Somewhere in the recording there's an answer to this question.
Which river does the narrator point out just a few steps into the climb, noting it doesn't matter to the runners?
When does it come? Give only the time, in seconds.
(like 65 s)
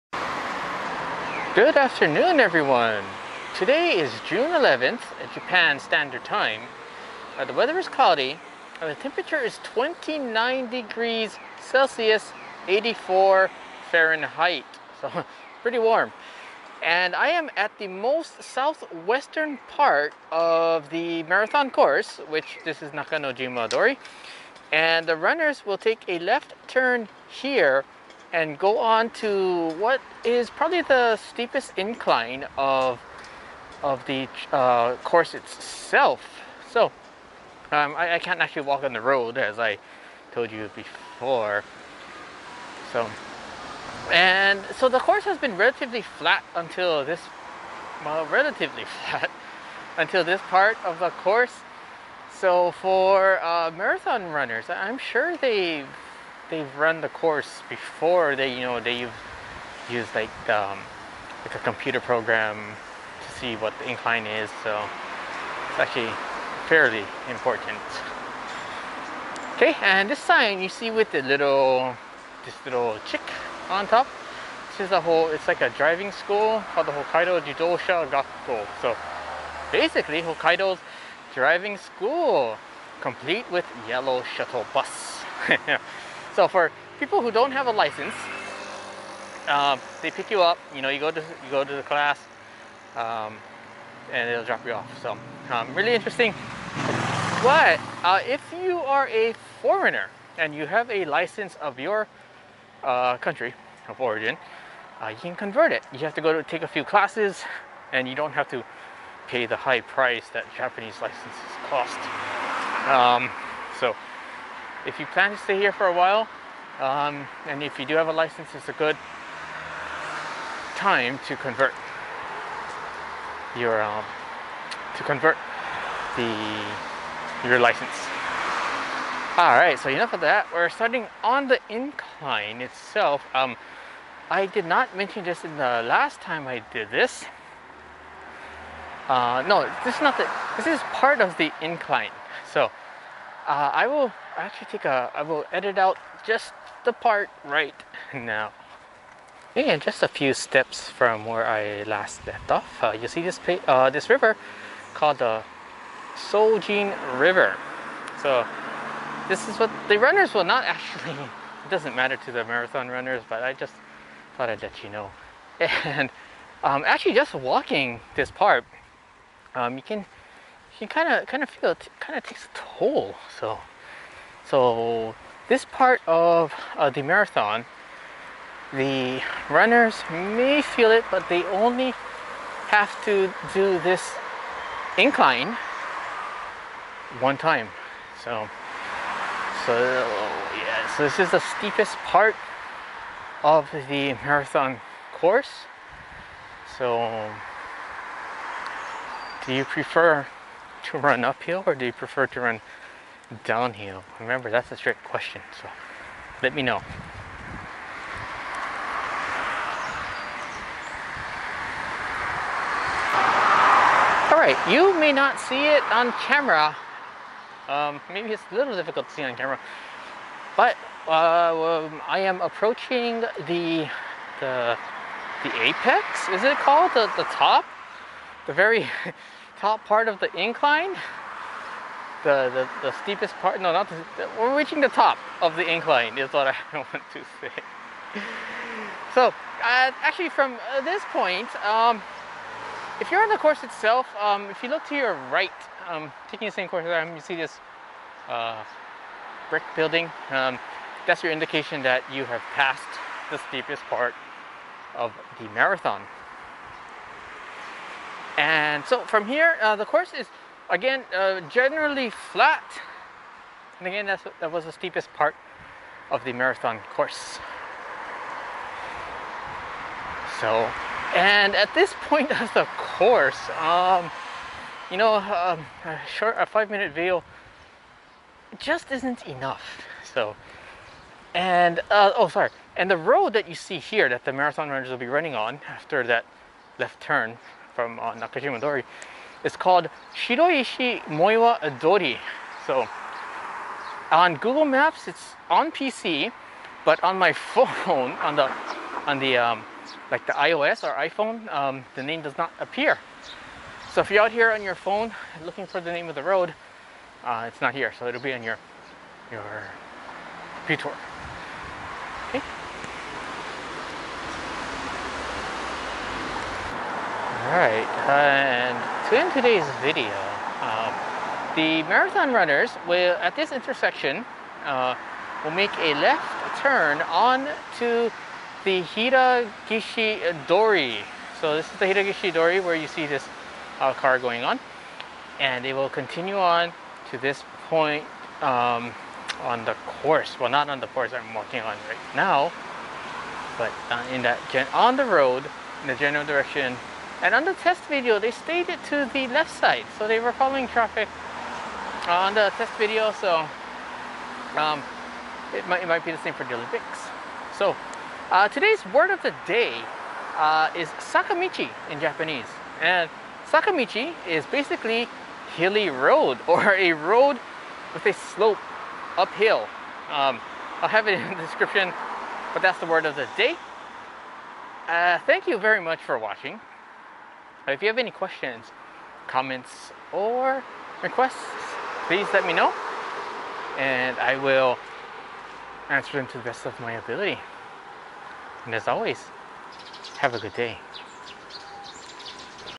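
156 s.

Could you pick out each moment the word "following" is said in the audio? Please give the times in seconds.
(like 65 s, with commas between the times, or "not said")
350 s.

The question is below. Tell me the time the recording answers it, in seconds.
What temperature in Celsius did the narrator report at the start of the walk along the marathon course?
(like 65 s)
9 s.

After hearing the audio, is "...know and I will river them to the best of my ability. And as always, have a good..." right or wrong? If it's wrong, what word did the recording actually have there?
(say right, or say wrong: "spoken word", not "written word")
wrong: "answer", not "river".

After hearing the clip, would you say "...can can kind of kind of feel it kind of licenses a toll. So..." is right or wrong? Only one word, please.
wrong.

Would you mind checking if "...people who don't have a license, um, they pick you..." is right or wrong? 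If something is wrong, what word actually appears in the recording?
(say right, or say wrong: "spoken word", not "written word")
right.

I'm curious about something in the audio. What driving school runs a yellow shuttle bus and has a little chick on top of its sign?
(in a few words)
Hokkaido Jidosha Gakko.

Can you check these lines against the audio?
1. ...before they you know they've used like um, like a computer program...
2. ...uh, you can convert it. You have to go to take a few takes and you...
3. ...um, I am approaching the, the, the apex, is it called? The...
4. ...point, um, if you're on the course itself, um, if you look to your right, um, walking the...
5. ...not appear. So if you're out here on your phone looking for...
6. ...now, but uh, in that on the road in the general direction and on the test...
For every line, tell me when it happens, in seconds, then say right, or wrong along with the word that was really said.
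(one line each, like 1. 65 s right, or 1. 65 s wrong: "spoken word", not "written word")
1. 57 s right
2. 105 s wrong: "classes", not "takes"
3. 221 s right
4. 241 s wrong: "taking", not "walking"
5. 302 s right
6. 342 s right.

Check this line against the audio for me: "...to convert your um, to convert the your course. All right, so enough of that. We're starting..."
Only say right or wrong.
wrong.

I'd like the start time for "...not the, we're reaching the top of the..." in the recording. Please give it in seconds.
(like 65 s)
233 s.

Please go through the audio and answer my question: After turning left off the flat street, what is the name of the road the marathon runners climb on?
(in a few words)
Shiroishi Moiwa Dori.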